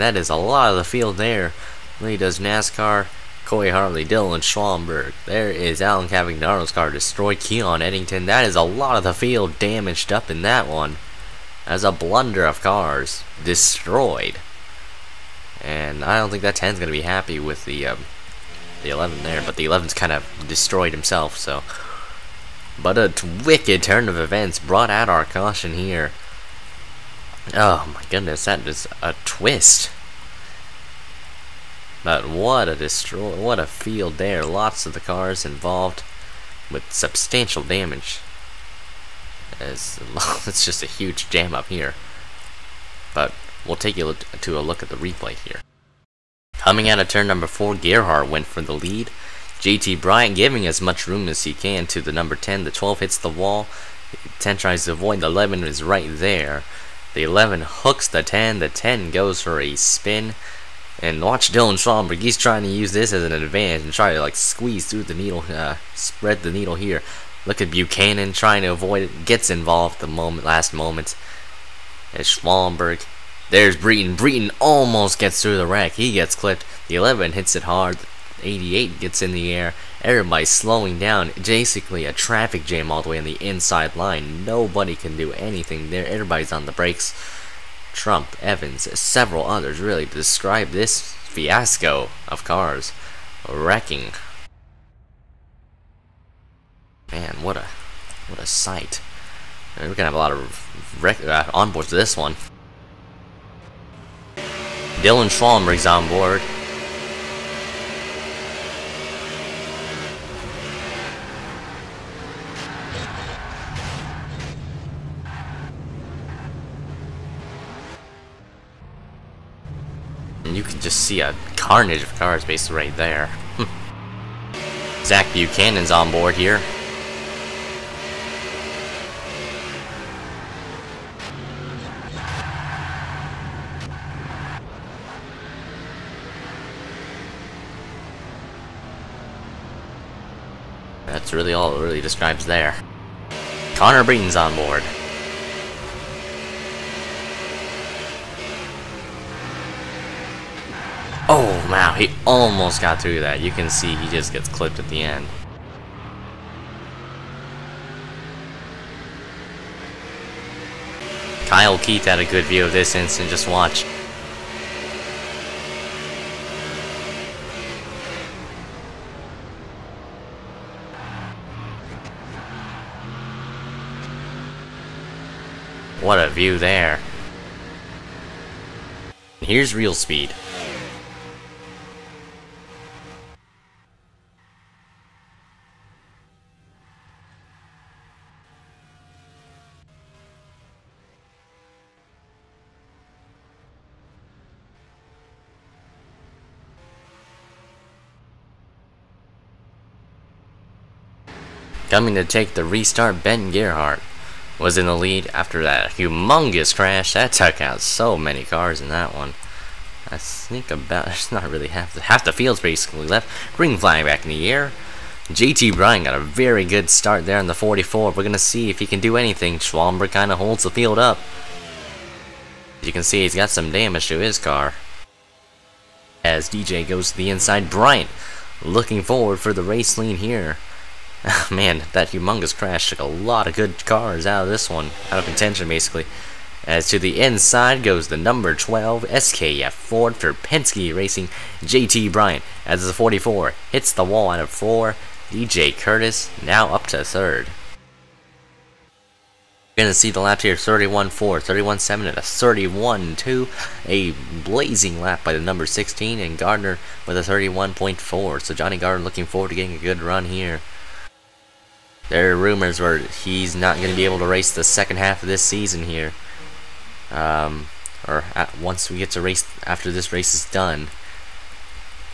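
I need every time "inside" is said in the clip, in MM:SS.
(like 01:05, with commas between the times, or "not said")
01:23, 03:47, 03:57.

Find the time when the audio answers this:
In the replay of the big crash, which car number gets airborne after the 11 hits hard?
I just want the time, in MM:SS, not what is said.
01:17.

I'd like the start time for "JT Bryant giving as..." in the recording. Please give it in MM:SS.
00:49.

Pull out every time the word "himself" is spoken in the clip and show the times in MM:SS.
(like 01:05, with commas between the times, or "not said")
00:20.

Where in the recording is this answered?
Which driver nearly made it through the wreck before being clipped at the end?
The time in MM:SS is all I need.
02:23.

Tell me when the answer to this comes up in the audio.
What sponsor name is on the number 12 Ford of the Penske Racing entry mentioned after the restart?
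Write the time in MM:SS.
03:59.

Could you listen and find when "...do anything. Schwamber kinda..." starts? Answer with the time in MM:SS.
03:39.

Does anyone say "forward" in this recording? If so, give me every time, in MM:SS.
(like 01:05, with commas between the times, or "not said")
03:49, 04:19.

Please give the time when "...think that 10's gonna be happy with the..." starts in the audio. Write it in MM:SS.
00:16.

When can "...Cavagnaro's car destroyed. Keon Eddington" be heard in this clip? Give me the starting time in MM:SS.
00:06.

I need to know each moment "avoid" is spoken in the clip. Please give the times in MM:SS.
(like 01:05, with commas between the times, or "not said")
00:54, 01:08.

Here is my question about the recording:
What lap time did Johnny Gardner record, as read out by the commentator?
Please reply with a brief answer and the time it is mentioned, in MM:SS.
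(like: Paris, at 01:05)
31.4, at 04:17.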